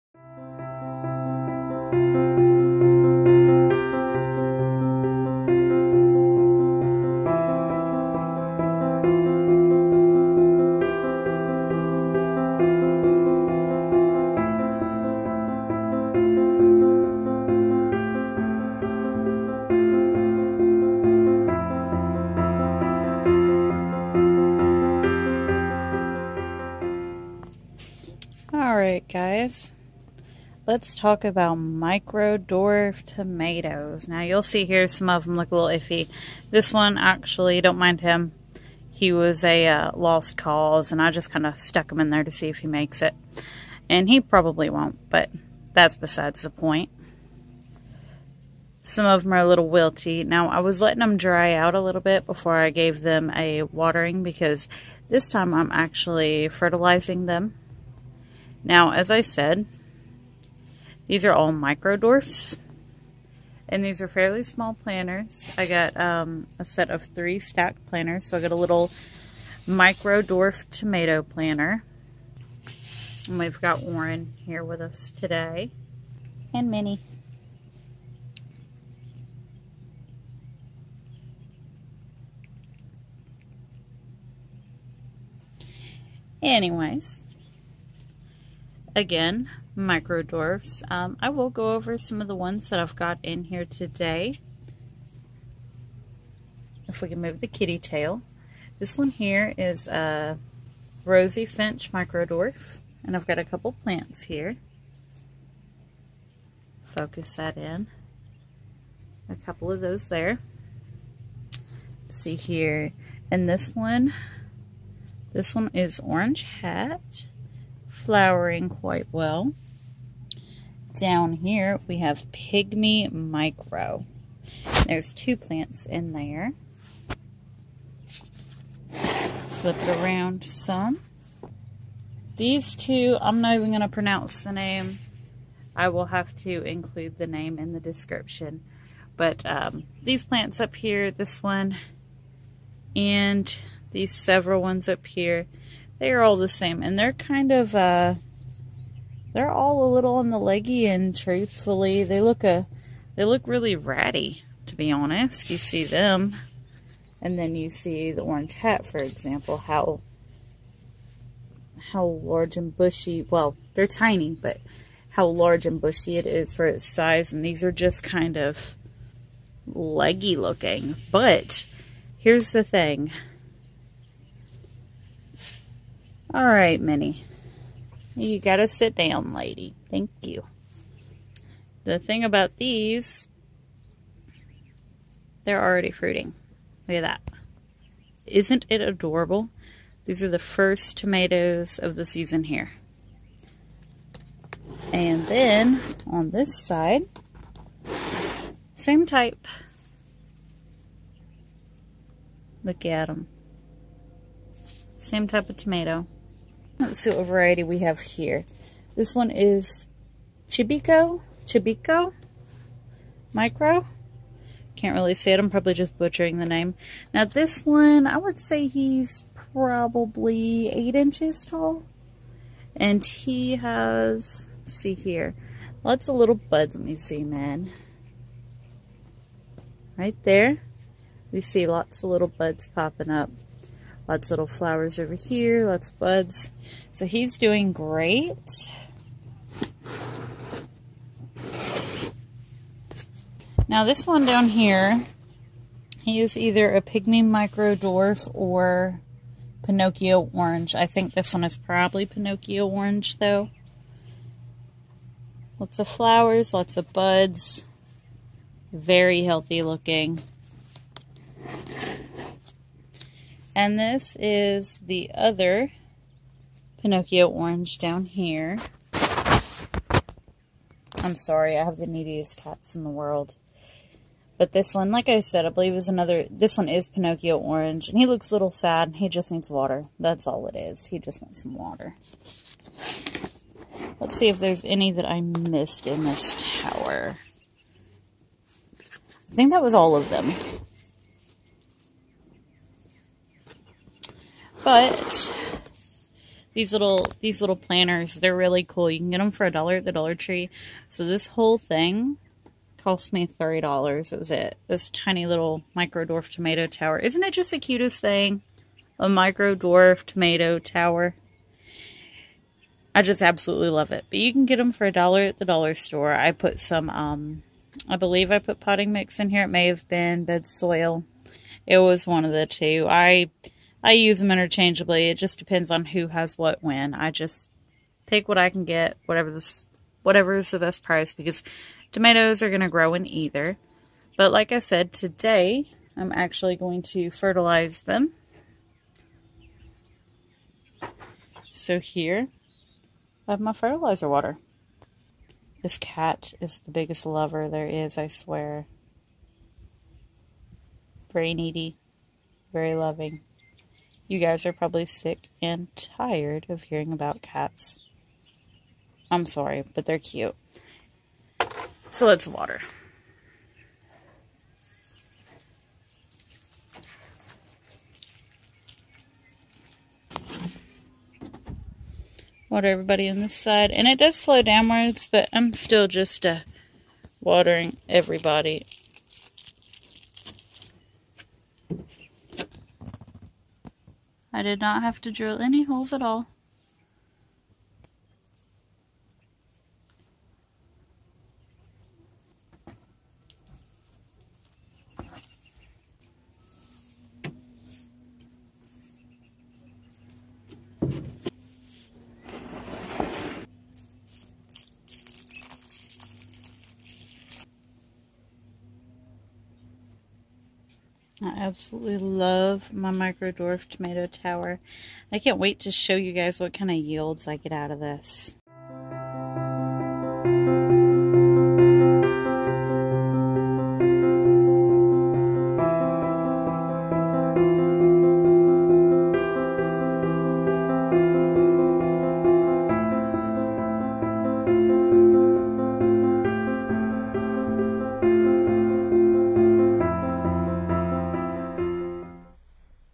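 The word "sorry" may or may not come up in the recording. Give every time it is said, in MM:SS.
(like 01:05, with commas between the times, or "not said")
04:31, 05:59.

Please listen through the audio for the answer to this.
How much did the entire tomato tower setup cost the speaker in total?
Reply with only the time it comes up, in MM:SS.
05:03.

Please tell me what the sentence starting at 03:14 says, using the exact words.
And then on this side, same type.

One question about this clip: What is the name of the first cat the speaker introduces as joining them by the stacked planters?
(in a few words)
Warren.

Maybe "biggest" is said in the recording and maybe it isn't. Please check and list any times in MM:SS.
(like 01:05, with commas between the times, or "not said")
05:46.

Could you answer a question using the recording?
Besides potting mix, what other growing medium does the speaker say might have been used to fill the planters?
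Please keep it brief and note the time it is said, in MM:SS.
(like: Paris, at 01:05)
bed soil, at 05:20.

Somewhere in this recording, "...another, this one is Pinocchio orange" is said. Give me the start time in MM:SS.
04:35.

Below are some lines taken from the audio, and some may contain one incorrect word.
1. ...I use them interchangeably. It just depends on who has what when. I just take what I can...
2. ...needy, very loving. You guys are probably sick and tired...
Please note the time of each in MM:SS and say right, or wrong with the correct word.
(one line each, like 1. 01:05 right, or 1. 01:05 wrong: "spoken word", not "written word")
1. 05:23 right
2. 05:51 right.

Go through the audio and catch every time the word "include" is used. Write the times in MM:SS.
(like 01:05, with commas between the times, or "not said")
02:16.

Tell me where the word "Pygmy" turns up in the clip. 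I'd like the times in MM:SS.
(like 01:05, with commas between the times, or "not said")
02:02, 04:06.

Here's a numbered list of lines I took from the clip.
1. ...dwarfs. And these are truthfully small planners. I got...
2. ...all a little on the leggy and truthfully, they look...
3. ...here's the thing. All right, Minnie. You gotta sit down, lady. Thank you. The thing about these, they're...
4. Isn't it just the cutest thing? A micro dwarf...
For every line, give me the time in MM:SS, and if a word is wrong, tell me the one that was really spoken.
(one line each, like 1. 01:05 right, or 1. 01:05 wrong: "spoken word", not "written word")
1. 01:01 wrong: "fairly", not "truthfully"
2. 02:29 right
3. 02:52 right
4. 05:06 right.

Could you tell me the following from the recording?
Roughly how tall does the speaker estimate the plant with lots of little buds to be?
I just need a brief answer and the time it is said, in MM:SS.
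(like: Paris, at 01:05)
8 inches, at 03:40.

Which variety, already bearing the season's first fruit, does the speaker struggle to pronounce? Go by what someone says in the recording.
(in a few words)
Chibikko Micro.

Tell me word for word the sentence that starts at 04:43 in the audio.
Let's see if there's any that I missed in this tower.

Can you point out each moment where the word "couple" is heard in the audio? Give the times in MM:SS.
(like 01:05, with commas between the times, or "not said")
01:43, 01:49.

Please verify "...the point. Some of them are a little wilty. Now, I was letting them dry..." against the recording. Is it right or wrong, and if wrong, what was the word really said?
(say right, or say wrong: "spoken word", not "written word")
right.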